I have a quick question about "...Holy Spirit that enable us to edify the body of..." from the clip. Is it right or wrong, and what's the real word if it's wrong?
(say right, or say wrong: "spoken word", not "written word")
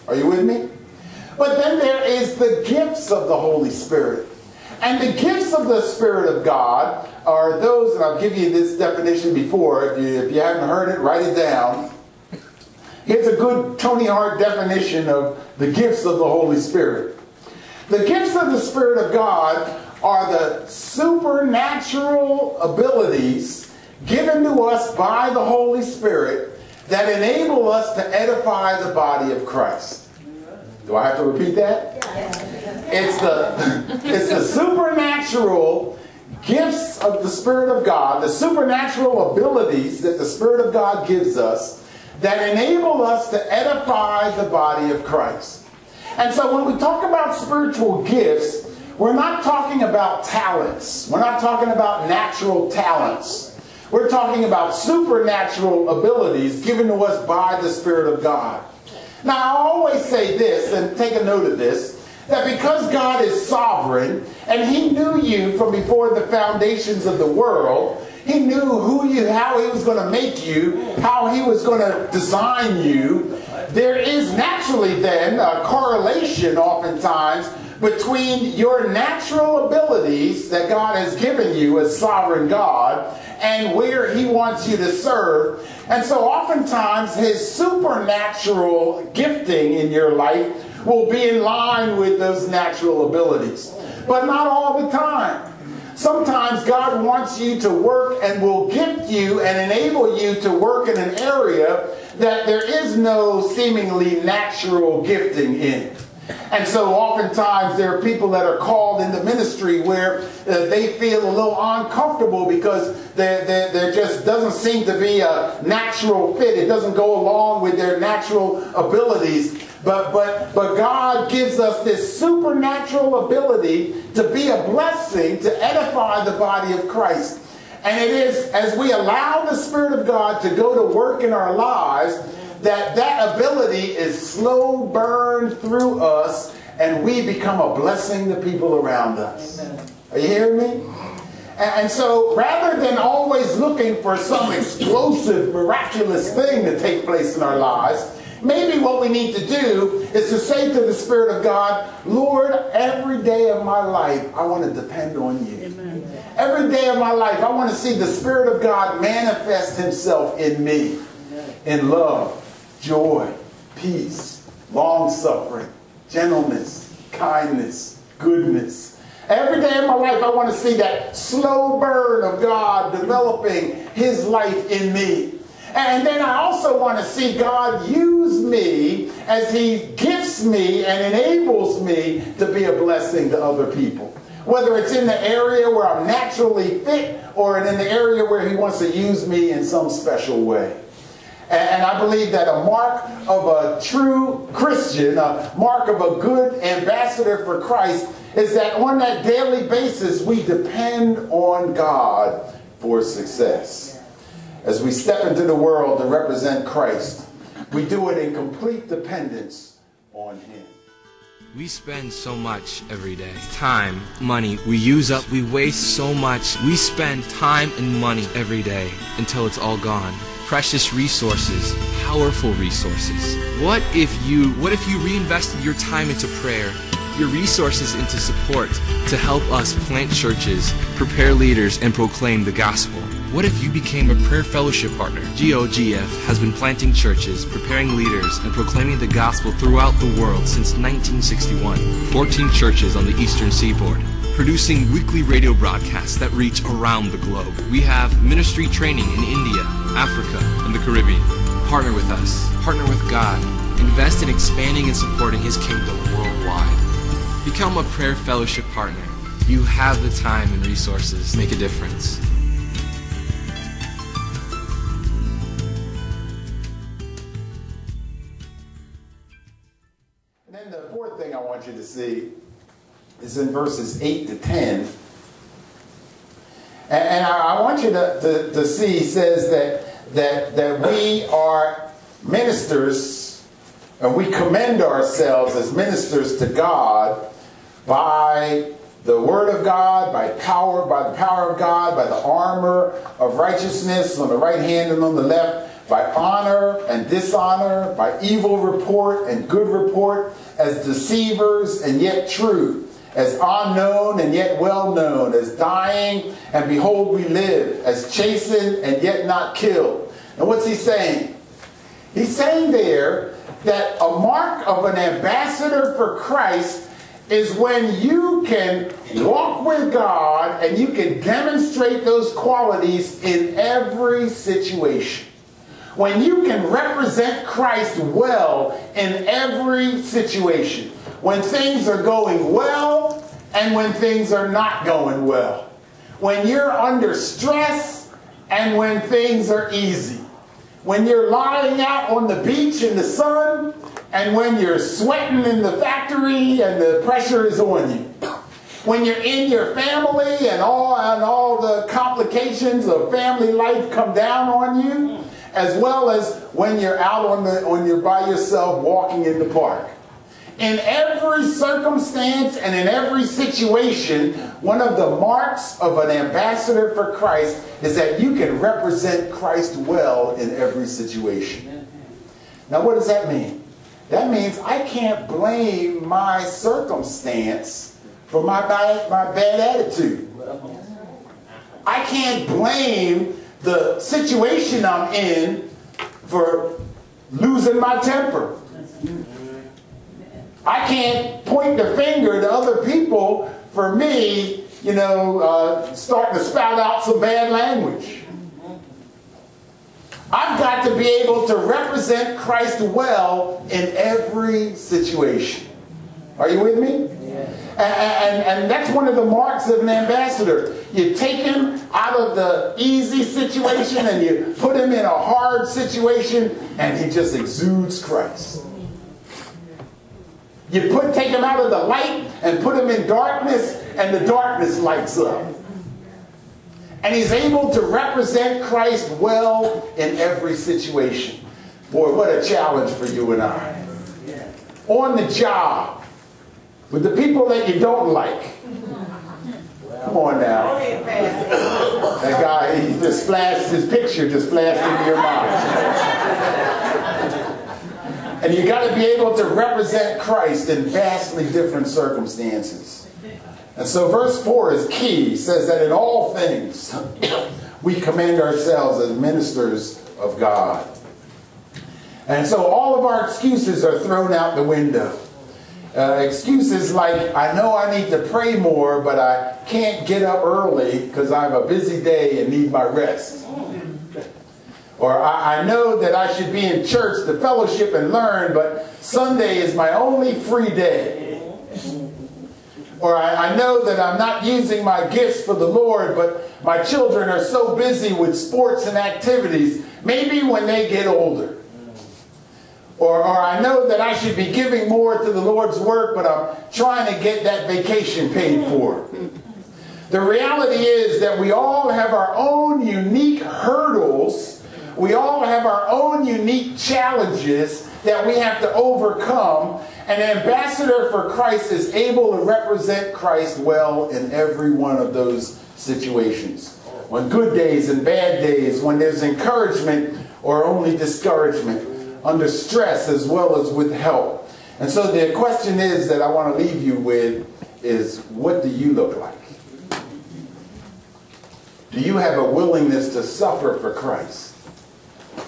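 right.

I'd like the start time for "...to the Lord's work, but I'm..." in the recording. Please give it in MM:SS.
08:15.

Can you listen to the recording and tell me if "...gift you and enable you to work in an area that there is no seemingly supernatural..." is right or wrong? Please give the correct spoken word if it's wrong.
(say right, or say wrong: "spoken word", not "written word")
wrong: "natural", not "supernatural".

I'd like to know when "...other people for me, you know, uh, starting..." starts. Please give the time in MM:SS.
06:32.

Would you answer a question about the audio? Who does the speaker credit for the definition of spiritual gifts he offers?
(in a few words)
Tony Hart.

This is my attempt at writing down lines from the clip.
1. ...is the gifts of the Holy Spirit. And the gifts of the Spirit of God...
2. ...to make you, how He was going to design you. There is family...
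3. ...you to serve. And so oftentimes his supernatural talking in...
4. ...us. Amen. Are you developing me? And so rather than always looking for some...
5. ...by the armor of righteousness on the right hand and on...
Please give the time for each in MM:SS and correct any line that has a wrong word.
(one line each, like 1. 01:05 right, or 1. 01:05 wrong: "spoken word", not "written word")
1. 00:02 right
2. 01:09 wrong: "naturally", not "family"
3. 01:24 wrong: "gifting", not "talking"
4. 02:19 wrong: "hearing", not "developing"
5. 04:51 right.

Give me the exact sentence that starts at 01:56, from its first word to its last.
It doesn't go along with their natural abilities.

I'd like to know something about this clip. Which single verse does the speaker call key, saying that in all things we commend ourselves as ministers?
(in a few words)
Verse 4.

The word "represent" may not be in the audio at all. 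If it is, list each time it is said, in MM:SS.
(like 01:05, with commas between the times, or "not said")
03:26, 05:26, 06:08, 06:41, 07:07, 07:29, 08:32.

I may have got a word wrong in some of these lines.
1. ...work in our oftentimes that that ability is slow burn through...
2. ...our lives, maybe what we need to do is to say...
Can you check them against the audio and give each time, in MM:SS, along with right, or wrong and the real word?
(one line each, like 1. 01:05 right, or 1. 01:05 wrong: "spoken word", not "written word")
1. 02:10 wrong: "lives", not "oftentimes"
2. 02:27 right.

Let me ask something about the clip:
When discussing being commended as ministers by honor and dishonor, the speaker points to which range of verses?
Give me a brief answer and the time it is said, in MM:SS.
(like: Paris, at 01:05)
Verses 8 to 10, at 04:33.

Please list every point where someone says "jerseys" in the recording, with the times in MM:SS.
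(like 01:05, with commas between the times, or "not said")
not said.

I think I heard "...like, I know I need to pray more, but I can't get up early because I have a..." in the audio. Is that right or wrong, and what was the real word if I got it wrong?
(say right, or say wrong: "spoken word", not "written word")
right.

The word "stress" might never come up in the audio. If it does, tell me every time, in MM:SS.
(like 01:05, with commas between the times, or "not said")
05:37, 08:42.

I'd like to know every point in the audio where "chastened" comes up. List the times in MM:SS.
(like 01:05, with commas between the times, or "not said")
05:08.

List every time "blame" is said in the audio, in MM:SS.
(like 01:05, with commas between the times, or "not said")
06:15, 06:22.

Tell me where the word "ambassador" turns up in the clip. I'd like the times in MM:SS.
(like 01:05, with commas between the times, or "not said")
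03:16, 05:14, 06:06, 06:49, 08:30.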